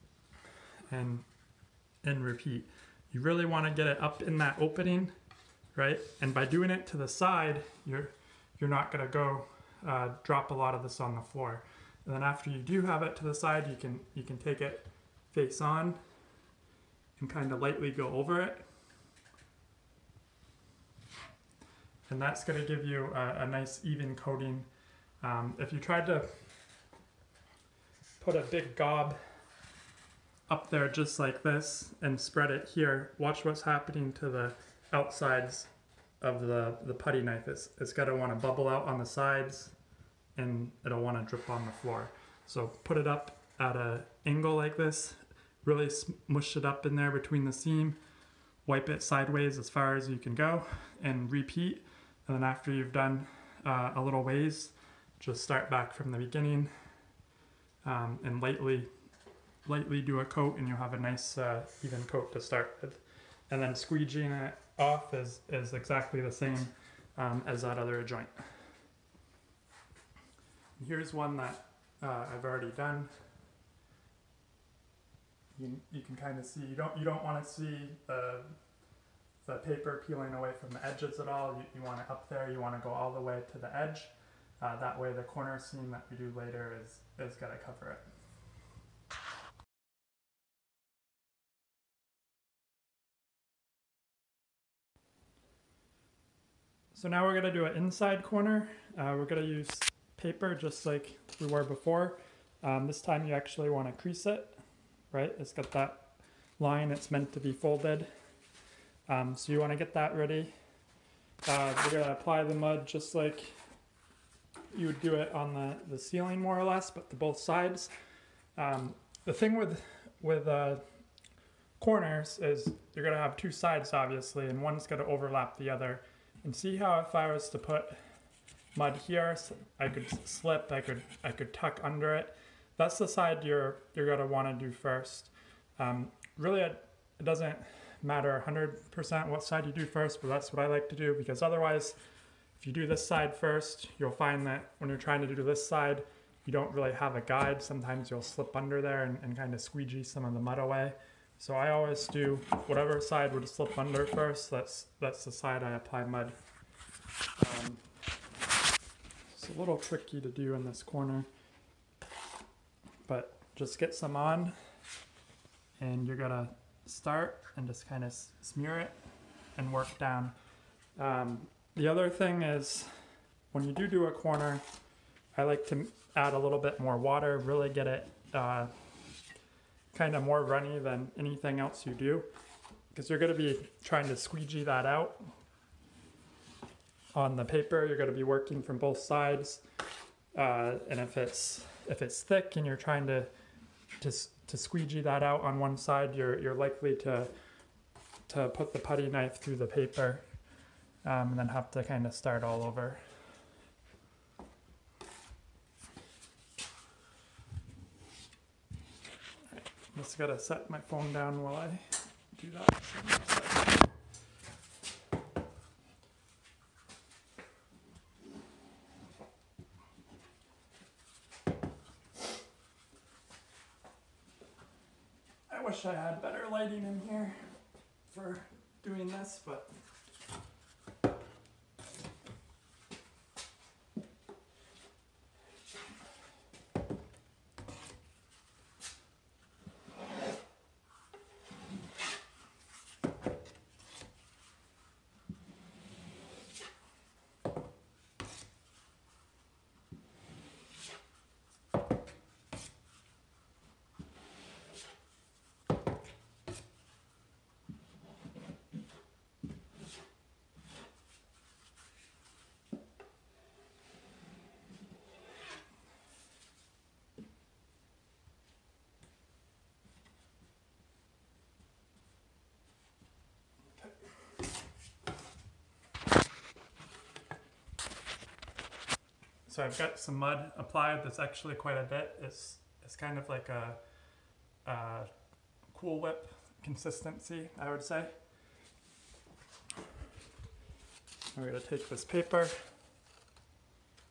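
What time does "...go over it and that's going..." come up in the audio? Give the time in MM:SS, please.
00:17.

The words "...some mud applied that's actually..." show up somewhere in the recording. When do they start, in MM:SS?
04:39.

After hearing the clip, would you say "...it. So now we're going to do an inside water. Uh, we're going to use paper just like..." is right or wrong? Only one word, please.
wrong.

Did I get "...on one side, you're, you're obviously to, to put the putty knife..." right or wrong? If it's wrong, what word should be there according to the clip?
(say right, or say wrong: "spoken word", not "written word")
wrong: "likely", not "obviously".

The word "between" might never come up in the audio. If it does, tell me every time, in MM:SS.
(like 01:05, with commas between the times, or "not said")
00:47.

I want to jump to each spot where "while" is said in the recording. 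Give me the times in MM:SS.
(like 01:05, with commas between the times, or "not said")
03:31.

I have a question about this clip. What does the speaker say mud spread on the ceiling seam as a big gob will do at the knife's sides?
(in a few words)
Bubble out.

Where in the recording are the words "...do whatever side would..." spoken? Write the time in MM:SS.
02:32.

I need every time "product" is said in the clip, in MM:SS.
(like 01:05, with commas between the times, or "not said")
not said.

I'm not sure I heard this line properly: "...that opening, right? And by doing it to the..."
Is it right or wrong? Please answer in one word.
right.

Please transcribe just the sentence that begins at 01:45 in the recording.
It's got that line it's meant to be folded um, so you want to get that ready.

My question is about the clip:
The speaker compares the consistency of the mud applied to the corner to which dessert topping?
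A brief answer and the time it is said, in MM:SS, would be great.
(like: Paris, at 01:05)
Cool Whip, at 04:45.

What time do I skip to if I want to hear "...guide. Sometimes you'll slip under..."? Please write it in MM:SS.
02:27.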